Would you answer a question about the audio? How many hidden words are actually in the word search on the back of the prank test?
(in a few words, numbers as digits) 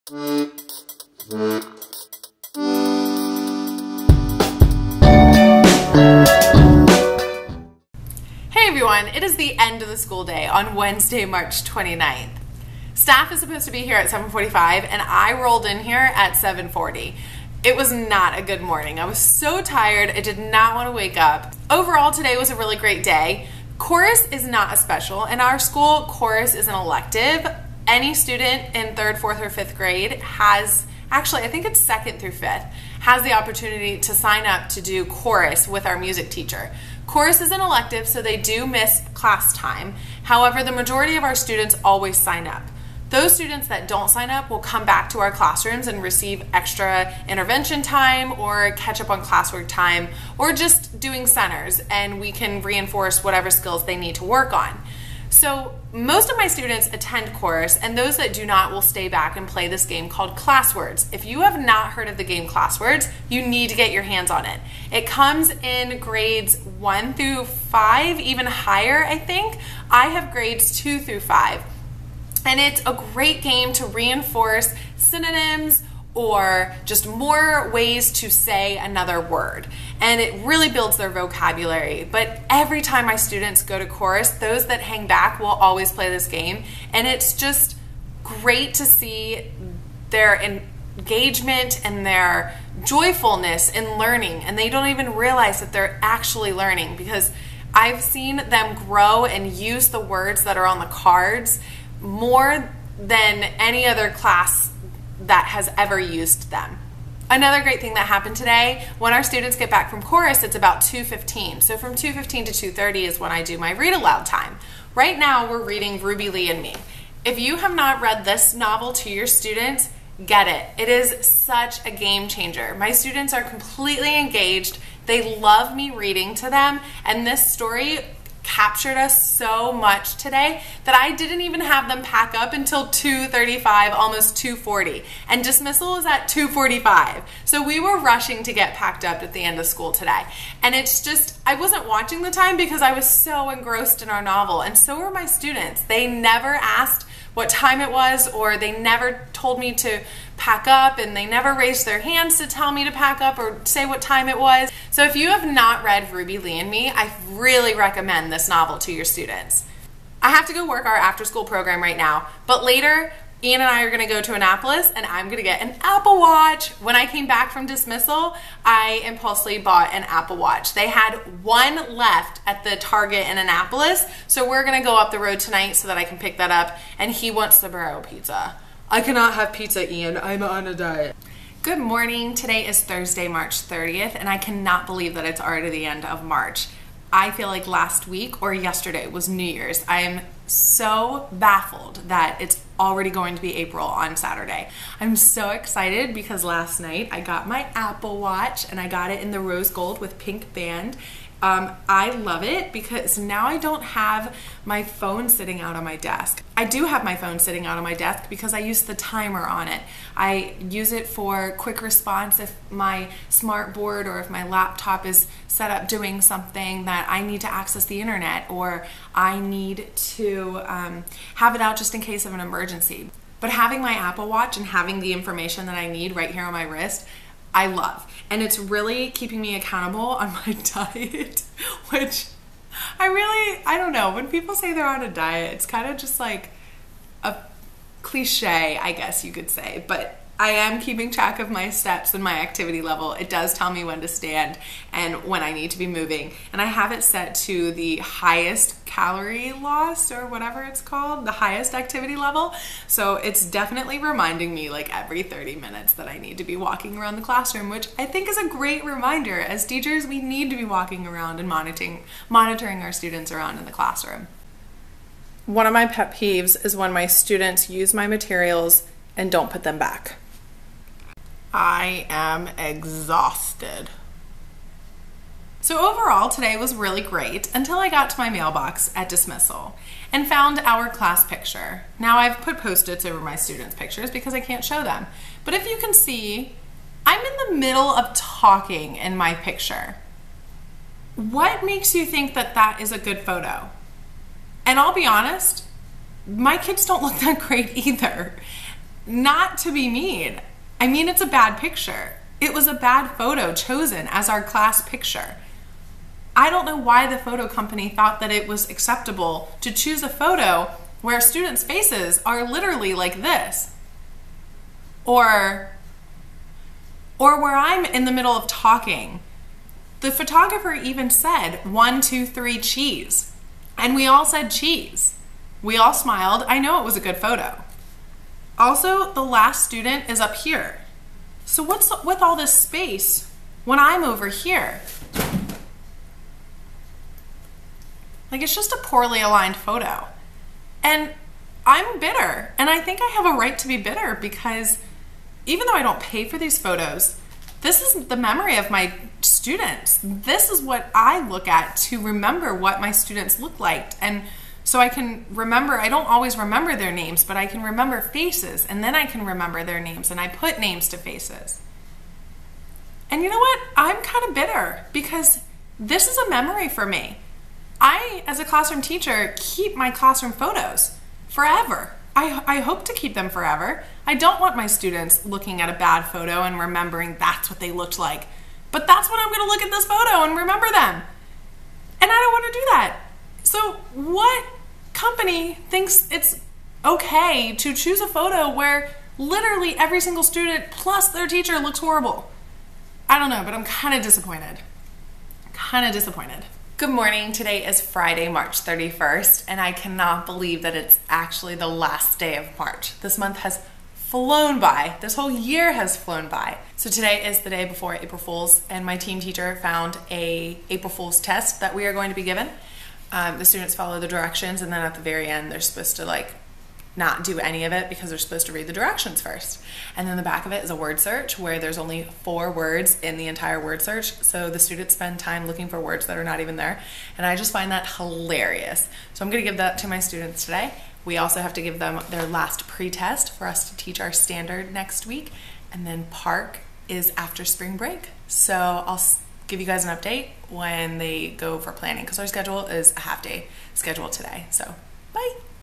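4.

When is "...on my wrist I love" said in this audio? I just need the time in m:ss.
3:46.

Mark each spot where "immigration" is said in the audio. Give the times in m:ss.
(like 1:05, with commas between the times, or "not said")
not said.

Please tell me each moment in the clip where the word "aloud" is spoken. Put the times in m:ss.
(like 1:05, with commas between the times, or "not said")
1:53.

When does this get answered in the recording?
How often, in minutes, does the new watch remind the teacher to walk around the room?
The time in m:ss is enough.
4:15.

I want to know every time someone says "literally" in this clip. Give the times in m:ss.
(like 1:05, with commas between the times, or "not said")
5:12, 6:29.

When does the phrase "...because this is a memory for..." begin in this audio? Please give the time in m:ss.
6:04.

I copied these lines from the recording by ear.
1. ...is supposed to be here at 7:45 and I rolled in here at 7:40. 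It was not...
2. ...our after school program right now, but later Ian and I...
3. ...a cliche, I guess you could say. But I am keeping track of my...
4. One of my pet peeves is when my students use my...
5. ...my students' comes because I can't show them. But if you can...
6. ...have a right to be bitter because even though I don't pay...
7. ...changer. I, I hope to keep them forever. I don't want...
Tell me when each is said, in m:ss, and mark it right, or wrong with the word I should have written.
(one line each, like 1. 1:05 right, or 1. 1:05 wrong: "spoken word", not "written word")
1. 0:13 right
2. 2:40 right
3. 3:57 right
4. 4:25 right
5. 4:43 wrong: "pictures", not "comes"
6. 5:43 right
7. 6:11 wrong: "forever", not "changer".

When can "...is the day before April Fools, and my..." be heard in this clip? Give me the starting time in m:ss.
6:47.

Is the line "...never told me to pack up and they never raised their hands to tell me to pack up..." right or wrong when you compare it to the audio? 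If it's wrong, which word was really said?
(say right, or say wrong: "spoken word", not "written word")
right.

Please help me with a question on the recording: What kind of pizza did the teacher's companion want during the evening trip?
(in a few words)
Barrero.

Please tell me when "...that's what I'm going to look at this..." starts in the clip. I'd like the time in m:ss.
6:18.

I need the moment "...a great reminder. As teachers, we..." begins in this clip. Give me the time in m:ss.
4:18.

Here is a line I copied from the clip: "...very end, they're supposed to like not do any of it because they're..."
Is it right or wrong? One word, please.
right.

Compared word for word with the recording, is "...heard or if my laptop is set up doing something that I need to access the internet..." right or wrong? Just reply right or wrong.
wrong.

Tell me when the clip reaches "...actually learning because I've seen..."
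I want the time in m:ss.
1:36.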